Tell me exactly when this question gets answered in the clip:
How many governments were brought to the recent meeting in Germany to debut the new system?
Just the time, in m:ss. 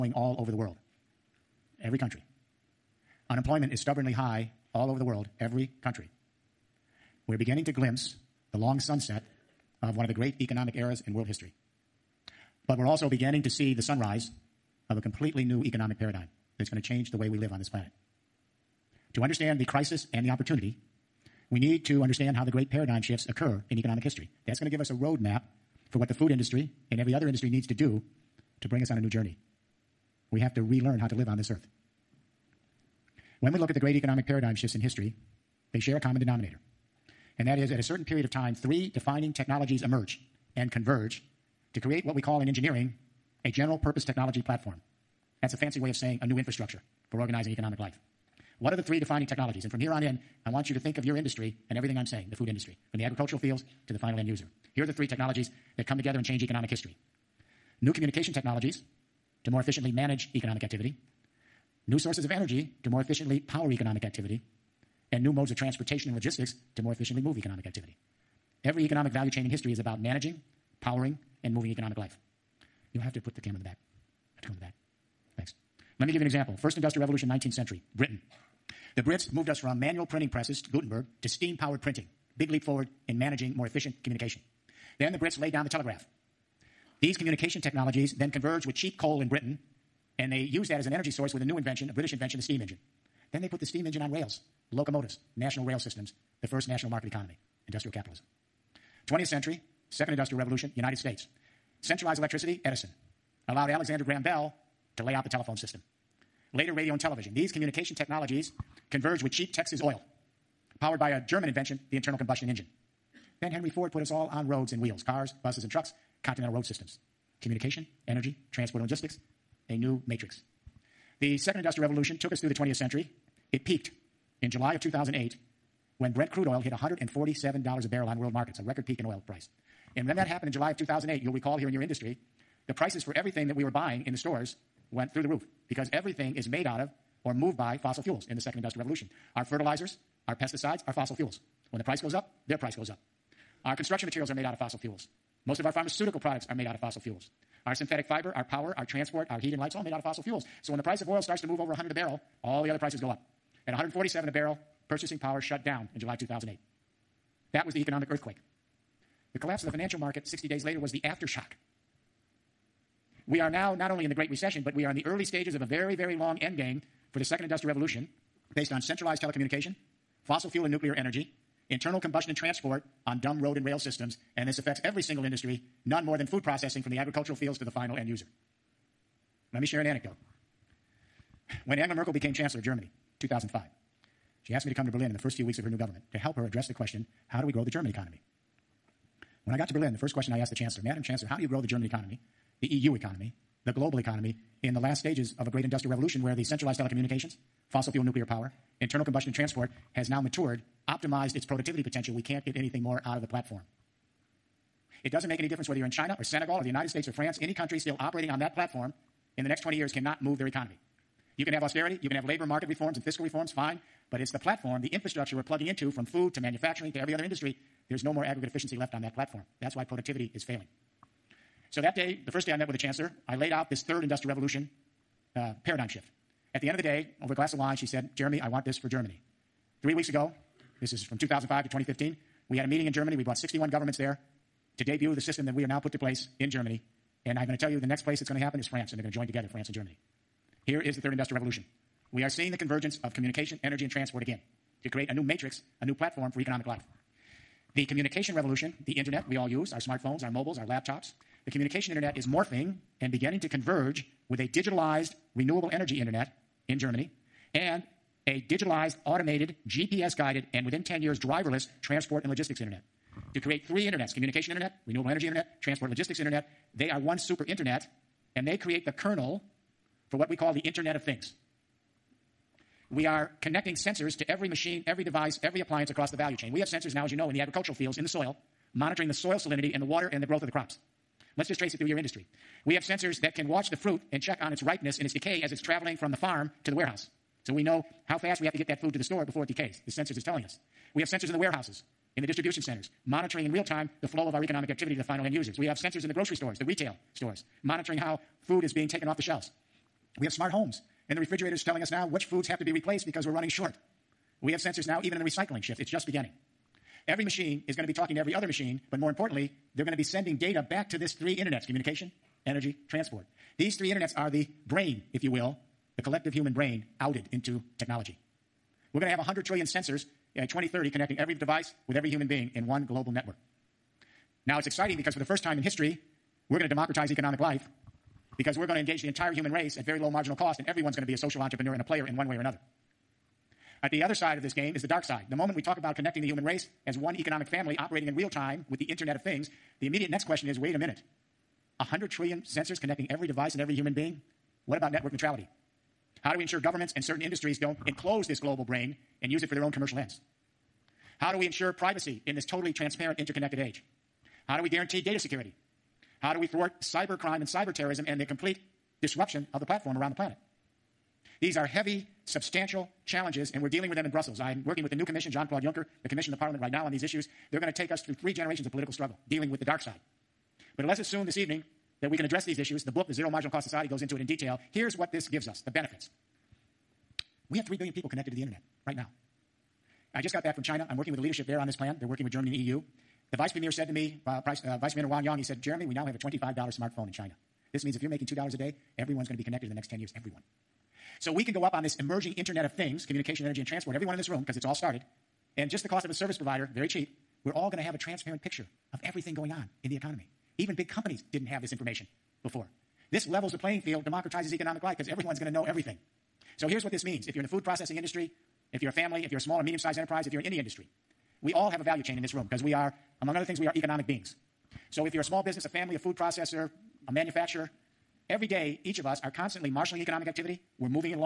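3:53.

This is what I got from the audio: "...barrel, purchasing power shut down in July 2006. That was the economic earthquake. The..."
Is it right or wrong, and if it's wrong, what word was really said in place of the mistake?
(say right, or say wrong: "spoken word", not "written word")
wrong: "2008", not "2006".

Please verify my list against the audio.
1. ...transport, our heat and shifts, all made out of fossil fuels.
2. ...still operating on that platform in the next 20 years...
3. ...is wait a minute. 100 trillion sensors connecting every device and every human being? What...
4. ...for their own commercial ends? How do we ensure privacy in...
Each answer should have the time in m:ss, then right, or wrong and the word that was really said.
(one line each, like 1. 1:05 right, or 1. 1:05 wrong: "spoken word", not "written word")
1. 2:28 wrong: "lights", not "shifts"
2. 3:27 right
3. 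5:40 right
4. 5:49 right.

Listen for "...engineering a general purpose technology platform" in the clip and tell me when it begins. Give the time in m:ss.
0:42.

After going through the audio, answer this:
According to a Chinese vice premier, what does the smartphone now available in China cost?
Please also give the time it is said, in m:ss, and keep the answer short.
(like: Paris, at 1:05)
$25, at 6:26.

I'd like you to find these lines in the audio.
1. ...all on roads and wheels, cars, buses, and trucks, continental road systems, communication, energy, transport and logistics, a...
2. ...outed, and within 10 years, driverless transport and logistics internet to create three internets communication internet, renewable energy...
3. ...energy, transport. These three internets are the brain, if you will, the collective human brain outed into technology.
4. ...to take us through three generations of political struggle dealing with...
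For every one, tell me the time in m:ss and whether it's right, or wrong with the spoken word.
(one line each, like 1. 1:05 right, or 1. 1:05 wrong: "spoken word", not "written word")
1. 1:54 right
2. 4:20 wrong: "guided", not "outed"
3. 5:12 right
4. 6:07 right.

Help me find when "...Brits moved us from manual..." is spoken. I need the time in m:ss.
1:19.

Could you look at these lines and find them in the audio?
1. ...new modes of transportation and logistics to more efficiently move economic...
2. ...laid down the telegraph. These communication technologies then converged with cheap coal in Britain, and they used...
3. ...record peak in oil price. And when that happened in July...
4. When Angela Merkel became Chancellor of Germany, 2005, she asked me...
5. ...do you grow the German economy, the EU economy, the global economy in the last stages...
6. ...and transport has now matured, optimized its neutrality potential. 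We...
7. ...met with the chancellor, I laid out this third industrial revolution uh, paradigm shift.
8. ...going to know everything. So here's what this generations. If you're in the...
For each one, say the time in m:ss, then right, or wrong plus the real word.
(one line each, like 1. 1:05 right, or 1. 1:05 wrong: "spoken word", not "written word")
1. 1:05 right
2. 1:25 right
3. 2:08 right
4. 3:01 right
5. 3:11 right
6. 3:19 wrong: "productivity", not "neutrality"
7. 3:42 right
8. 6:45 wrong: "means", not "generations".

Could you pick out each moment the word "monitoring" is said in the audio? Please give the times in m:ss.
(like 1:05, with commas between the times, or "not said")
4:38, 4:53, 4:57.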